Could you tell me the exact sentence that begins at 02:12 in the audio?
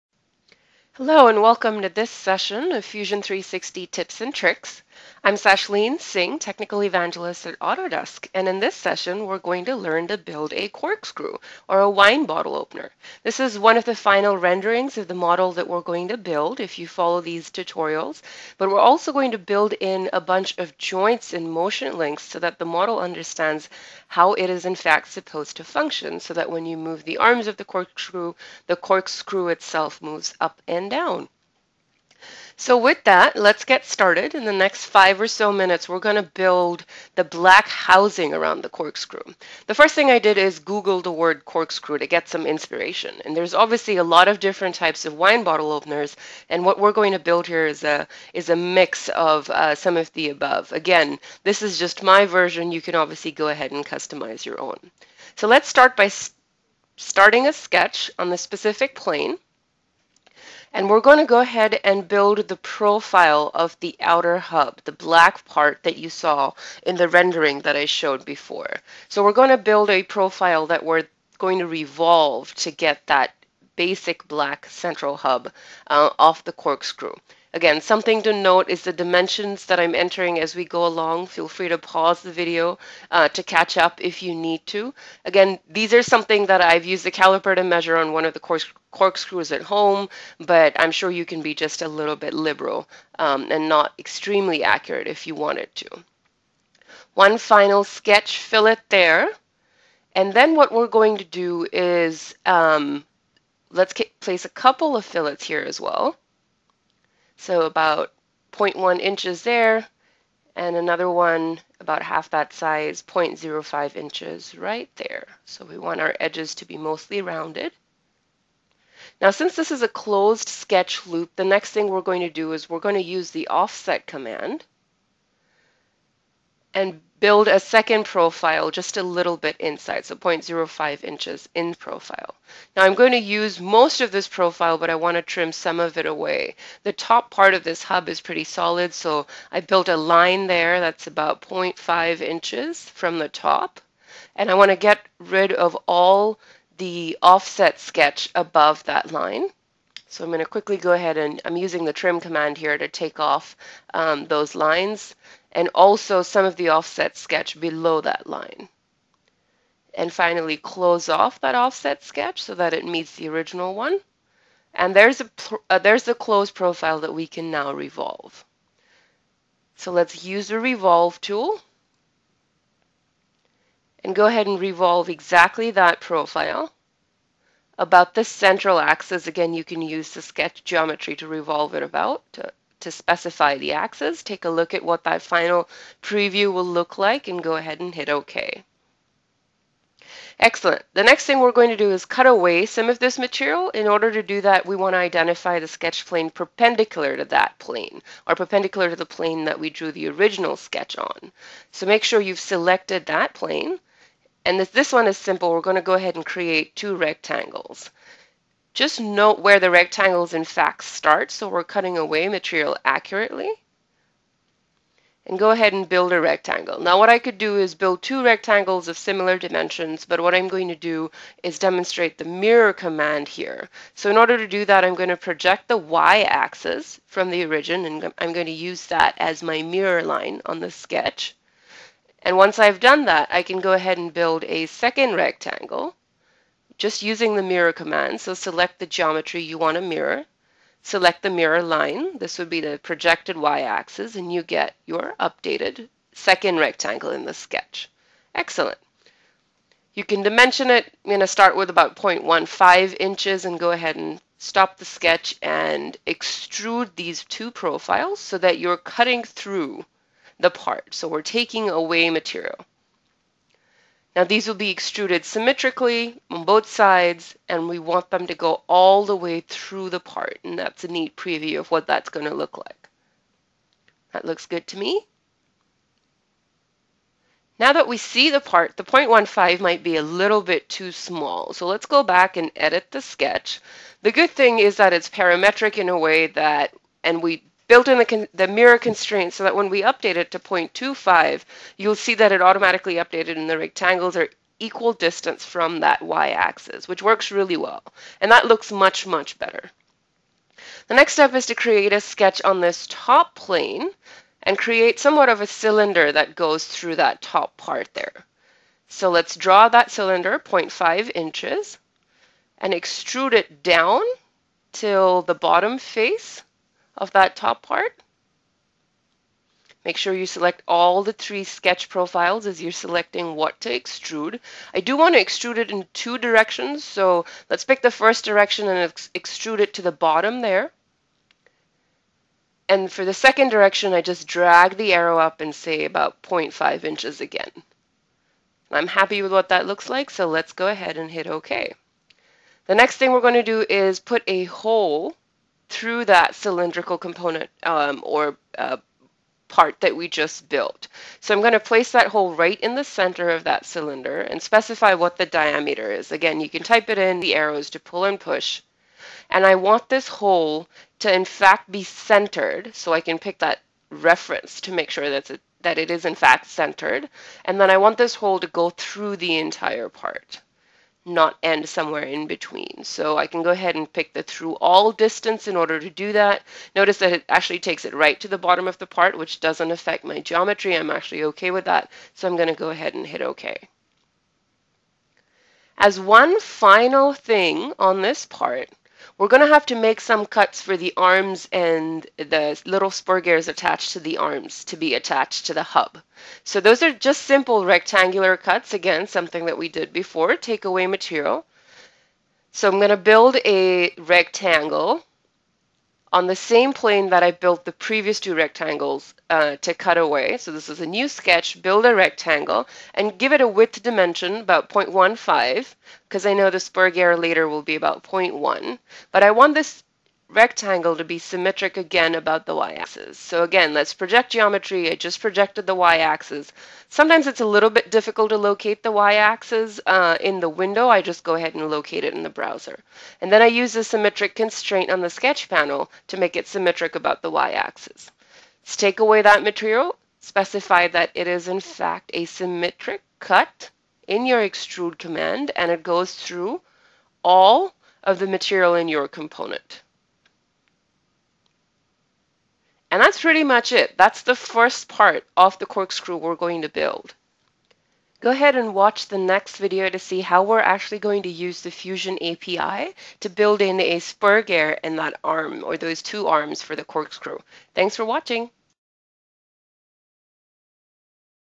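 Now I'm going to use most of this profile, but I want to trim some of it away.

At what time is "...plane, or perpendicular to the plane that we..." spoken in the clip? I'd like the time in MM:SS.
03:17.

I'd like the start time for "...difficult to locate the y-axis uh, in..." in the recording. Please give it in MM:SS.
07:07.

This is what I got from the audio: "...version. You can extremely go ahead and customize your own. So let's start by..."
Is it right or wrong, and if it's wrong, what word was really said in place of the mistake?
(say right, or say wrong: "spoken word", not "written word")
wrong: "obviously", not "extremely".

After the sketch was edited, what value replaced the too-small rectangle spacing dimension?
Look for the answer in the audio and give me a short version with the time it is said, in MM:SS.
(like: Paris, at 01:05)
0.25, at 04:50.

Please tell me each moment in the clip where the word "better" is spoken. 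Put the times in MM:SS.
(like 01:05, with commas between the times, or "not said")
04:59.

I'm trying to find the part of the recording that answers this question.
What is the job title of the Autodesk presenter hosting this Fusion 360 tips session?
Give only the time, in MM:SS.
00:06.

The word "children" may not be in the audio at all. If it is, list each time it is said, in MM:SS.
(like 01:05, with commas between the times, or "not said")
not said.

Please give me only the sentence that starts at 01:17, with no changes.
Again, something to note is the dimensions that I'm entering as we go along.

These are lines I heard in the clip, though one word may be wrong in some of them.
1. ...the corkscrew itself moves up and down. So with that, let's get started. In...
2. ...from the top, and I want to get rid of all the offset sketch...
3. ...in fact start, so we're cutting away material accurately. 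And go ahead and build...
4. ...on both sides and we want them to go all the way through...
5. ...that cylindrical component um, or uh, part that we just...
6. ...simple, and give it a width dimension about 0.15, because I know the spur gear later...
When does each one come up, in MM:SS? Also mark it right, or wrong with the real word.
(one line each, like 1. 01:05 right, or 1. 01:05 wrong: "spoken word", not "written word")
1. 00:28 right
2. 02:22 right
3. 03:30 right
4. 04:26 right
5. 05:46 right
6. 06:51 wrong: "rectangle", not "simple".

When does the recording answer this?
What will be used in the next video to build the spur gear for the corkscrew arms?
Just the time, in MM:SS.
07:41.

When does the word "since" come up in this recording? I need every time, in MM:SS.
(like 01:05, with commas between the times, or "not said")
01:59.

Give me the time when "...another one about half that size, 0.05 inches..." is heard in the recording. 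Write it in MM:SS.
01:50.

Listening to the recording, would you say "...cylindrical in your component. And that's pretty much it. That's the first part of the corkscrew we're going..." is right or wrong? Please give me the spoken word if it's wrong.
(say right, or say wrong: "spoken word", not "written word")
wrong: "material", not "cylindrical".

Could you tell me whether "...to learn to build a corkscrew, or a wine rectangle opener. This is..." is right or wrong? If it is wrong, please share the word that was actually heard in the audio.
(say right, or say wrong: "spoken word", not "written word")
wrong: "bottle", not "rectangle".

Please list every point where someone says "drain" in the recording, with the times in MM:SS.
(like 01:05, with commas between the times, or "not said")
not said.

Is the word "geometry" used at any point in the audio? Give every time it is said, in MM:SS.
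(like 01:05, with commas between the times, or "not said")
03:00, 03:58, 06:20, 07:04.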